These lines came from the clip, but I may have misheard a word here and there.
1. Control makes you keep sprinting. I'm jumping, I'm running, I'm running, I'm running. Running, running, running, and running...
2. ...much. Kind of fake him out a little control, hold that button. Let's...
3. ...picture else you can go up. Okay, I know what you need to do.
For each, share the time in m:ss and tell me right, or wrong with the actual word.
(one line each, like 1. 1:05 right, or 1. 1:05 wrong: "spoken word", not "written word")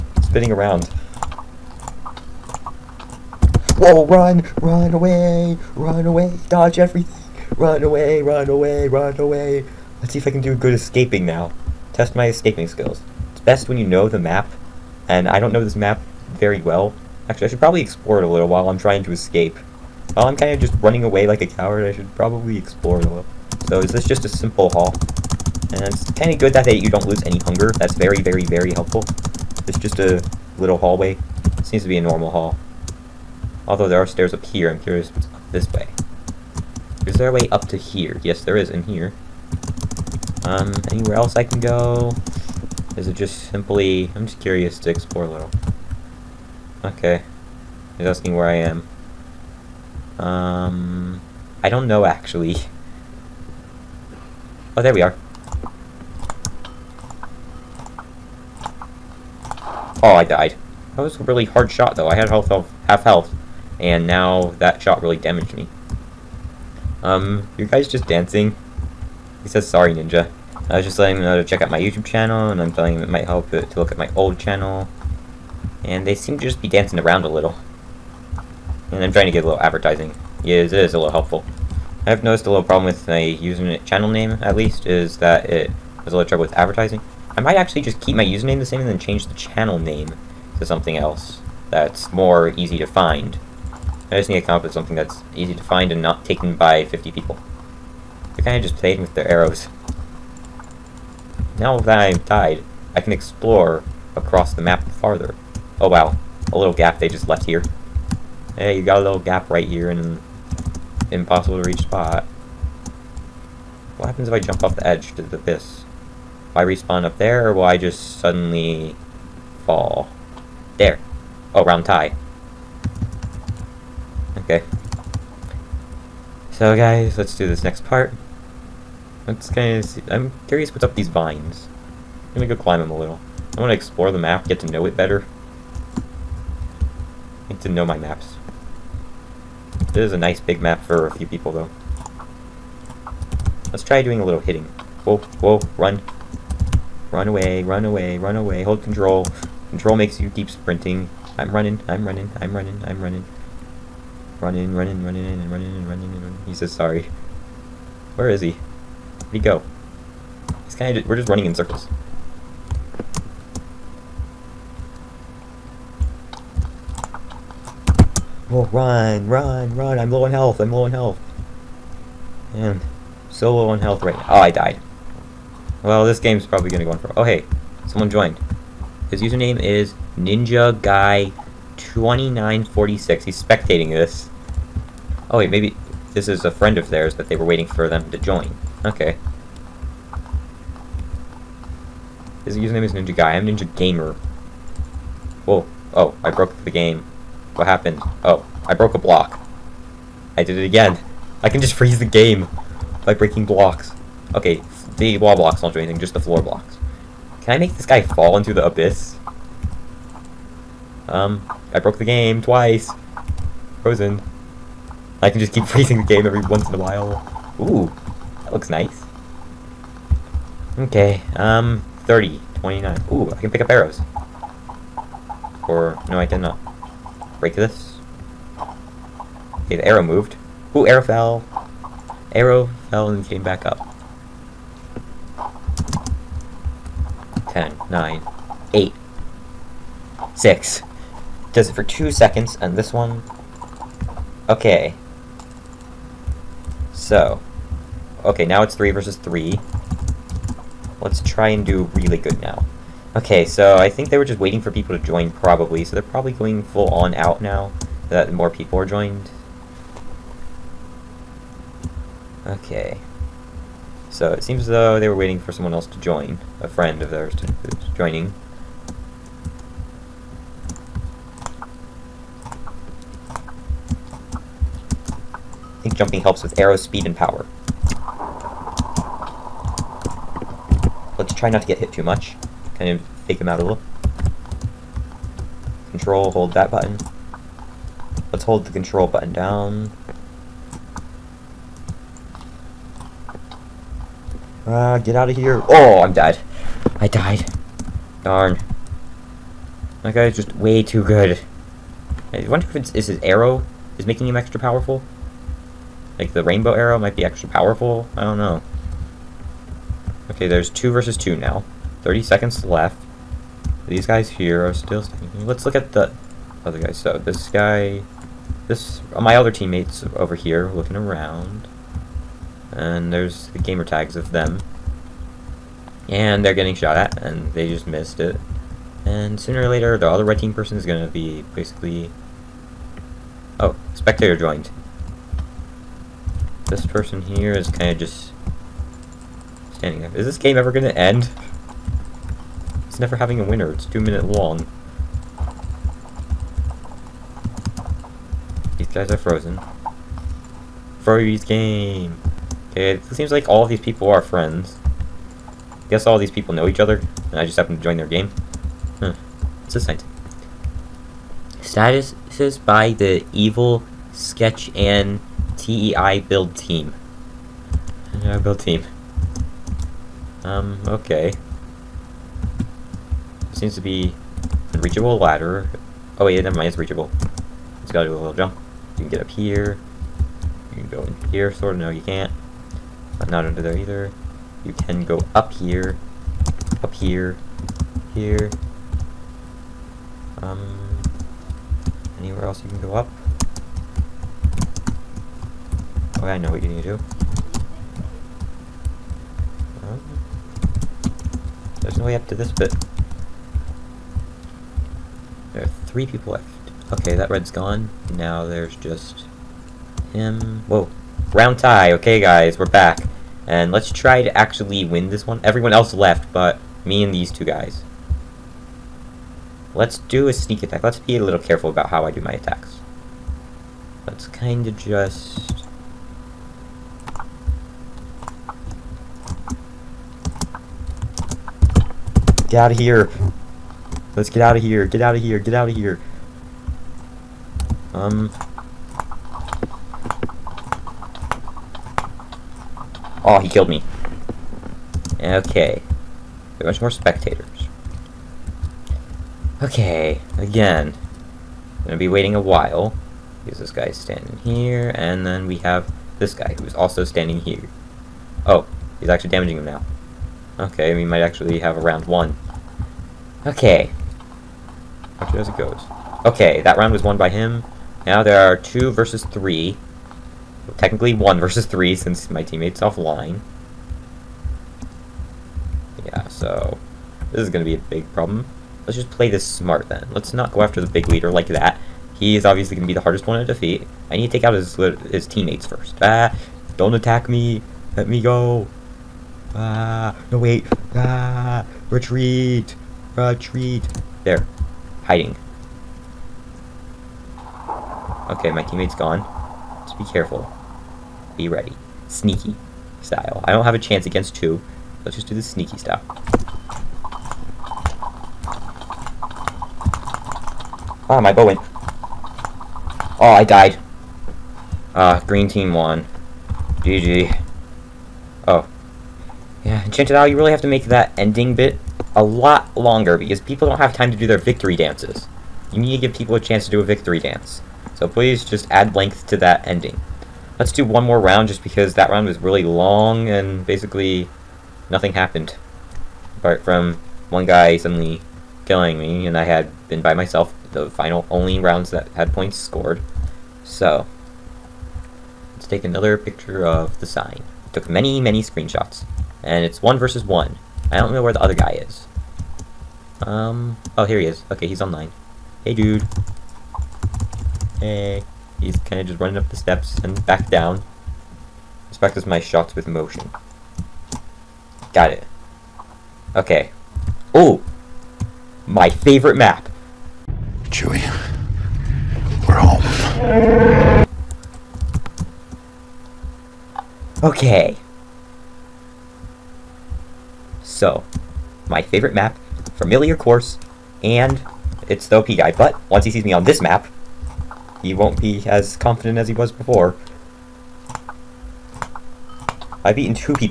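1. 2:29 wrong: "running", not "jumping"
2. 4:42 right
3. 6:32 wrong: "anywhere", not "picture".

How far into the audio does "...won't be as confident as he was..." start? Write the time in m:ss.
9:47.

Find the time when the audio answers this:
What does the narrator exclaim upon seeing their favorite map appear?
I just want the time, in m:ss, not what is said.
9:30.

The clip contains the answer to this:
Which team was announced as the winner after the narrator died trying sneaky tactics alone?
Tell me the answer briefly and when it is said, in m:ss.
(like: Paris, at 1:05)
Green team, at 8:35.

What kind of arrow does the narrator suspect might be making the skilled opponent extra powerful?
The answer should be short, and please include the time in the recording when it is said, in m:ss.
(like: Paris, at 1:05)
Rainbow arrow, at 5:06.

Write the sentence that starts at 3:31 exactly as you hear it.
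Um, I broke the game twice.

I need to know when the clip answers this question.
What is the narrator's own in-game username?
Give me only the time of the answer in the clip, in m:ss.
3:13.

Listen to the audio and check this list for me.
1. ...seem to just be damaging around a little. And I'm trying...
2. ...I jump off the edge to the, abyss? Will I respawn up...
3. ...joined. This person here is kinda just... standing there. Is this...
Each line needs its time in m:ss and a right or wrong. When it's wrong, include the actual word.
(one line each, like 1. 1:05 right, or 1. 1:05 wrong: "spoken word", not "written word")
1. 1:16 wrong: "dancing", not "damaging"
2. 1:54 right
3. 5:34 right.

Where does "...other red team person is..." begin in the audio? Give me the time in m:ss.
5:30.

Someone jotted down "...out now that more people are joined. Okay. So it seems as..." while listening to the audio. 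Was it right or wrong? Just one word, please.
right.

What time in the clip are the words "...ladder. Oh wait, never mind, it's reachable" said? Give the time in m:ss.
6:15.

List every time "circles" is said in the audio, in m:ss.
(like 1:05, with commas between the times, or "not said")
2:41.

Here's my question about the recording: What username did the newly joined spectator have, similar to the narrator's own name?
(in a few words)
Ninja Guy 2946.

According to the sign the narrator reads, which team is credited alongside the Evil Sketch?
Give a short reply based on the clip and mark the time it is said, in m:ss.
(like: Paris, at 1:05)
TEI Build Team, at 6:05.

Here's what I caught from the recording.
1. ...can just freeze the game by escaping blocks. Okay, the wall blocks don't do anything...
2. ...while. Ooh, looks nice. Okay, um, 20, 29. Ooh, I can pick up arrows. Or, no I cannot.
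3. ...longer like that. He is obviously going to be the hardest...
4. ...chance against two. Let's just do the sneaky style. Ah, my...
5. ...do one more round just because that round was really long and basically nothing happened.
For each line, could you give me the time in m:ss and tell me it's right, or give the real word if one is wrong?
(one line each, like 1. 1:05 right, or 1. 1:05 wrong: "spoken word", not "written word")
1. 3:21 wrong: "breaking", not "escaping"
2. 3:36 wrong: "30", not "20"
3. 8:01 wrong: "leader", not "longer"
4. 8:23 right
5. 8:50 right.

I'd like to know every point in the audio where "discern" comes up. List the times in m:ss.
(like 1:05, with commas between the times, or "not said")
not said.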